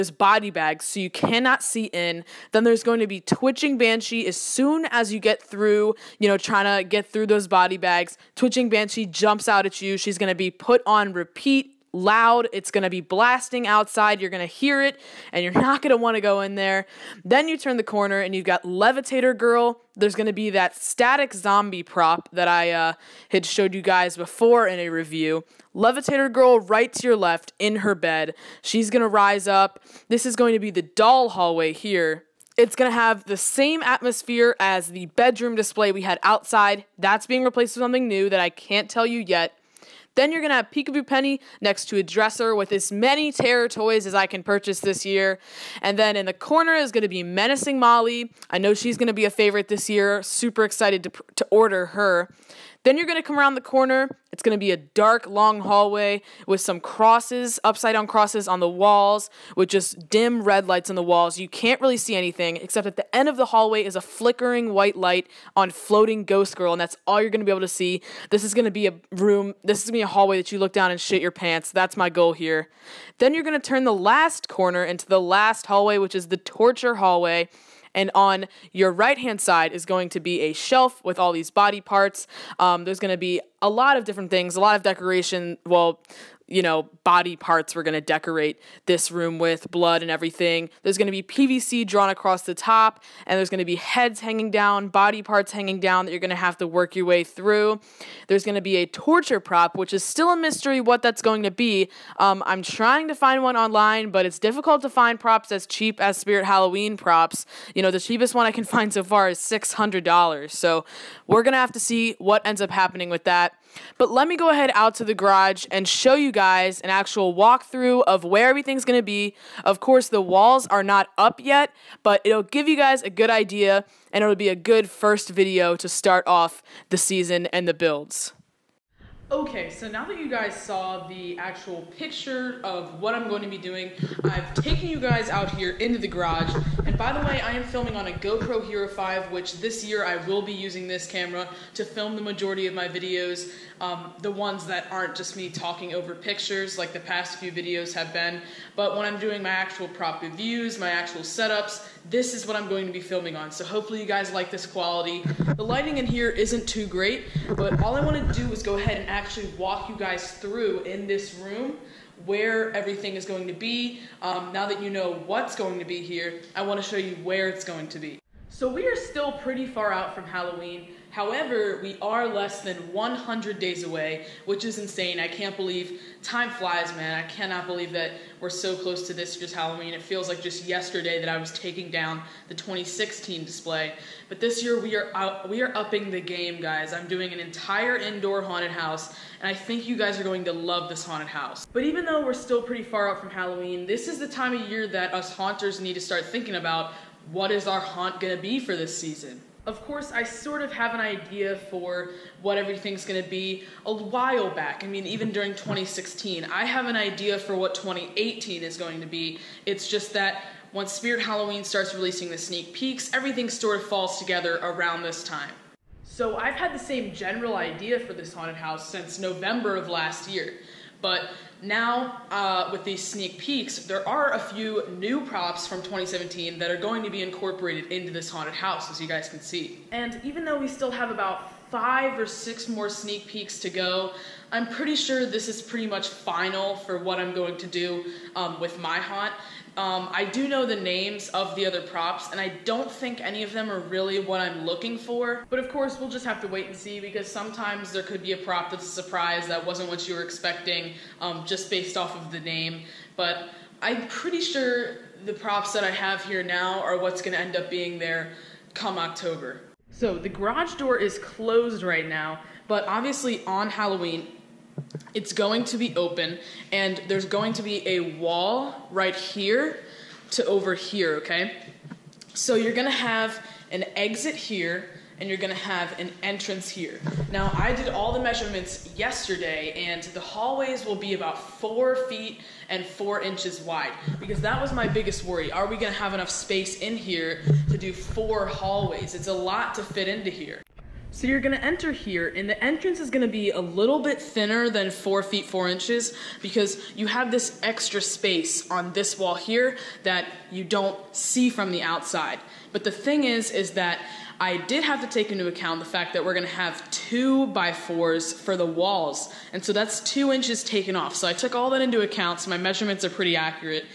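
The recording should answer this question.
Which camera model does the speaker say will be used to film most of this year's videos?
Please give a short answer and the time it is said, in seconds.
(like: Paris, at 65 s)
GoPro Hero 5, at 138 s.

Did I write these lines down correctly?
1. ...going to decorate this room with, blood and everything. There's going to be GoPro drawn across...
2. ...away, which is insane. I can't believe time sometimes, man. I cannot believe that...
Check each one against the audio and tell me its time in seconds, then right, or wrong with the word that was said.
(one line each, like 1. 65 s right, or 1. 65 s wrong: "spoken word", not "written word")
1. 87 s wrong: "PVC", not "GoPro"
2. 173 s wrong: "flies", not "sometimes".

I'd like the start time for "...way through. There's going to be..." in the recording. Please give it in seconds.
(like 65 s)
97 s.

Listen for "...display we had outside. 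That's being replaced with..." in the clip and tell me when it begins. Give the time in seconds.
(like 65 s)
35 s.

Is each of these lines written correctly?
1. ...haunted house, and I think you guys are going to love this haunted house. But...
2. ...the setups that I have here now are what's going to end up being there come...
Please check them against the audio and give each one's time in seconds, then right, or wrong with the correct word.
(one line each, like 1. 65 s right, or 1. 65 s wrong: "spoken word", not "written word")
1. 188 s right
2. 255 s wrong: "props", not "setups".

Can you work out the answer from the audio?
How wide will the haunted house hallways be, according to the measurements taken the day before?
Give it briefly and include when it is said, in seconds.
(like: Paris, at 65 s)
4 feet 4 inches, at 281 s.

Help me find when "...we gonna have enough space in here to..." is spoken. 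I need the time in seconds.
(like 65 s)
285 s.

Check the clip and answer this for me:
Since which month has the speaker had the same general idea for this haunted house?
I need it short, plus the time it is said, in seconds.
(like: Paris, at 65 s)
November, at 219 s.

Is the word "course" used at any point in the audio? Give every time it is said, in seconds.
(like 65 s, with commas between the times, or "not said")
119 s, 199 s, 245 s.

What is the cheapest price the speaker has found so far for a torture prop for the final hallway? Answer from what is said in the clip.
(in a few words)
$600.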